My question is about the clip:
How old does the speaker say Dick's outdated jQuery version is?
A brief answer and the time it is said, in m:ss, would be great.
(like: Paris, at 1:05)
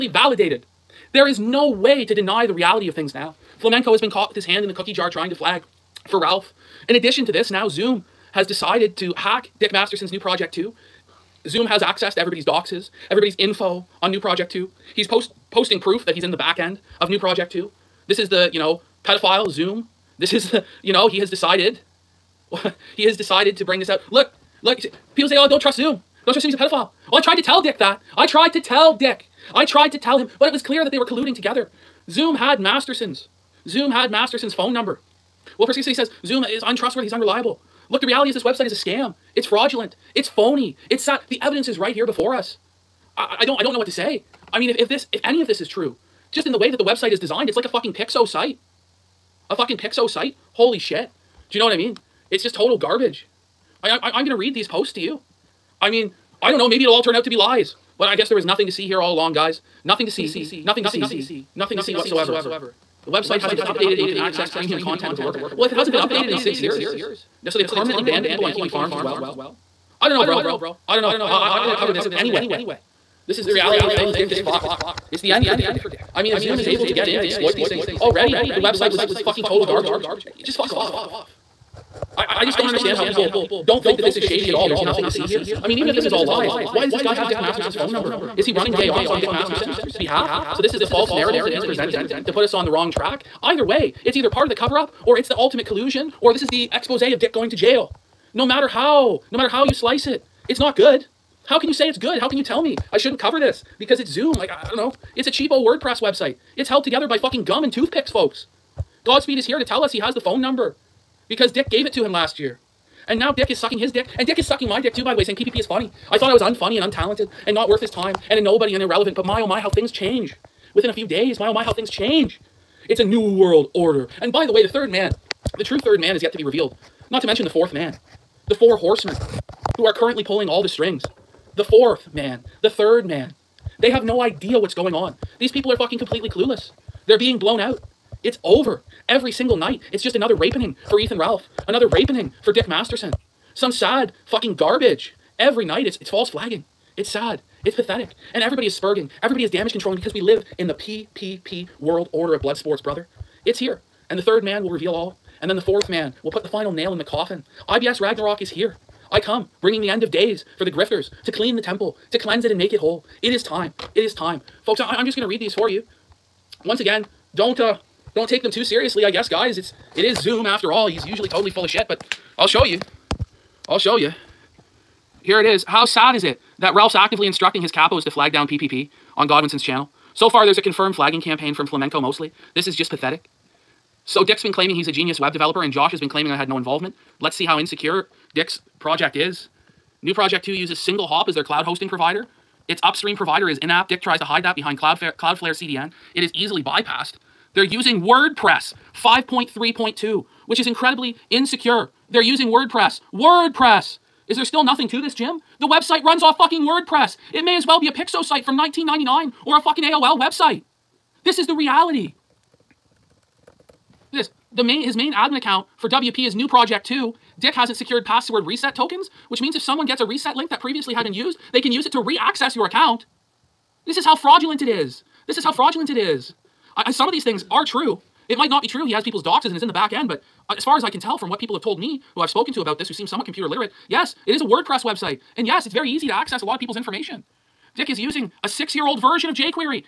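6 years old, at 3:58.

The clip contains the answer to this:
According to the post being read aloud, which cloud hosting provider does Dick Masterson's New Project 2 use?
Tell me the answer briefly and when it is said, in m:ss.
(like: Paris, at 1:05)
Single Hop, at 3:10.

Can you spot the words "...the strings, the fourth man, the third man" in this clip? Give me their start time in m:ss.
2:10.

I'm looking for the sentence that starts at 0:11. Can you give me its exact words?
Zoom has access to everybody's doxes, everybody's info on new project too.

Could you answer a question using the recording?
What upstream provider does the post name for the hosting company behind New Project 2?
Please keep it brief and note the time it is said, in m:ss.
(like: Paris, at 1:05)
InApp, at 3:13.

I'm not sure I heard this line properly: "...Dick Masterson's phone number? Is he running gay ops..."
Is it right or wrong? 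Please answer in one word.
right.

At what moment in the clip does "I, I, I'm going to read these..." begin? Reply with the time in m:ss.
0:53.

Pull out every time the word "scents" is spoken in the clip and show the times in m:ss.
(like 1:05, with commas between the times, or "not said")
not said.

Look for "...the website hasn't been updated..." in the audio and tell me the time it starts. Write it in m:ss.
1:03.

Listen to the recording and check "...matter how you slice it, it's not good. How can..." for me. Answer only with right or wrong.
right.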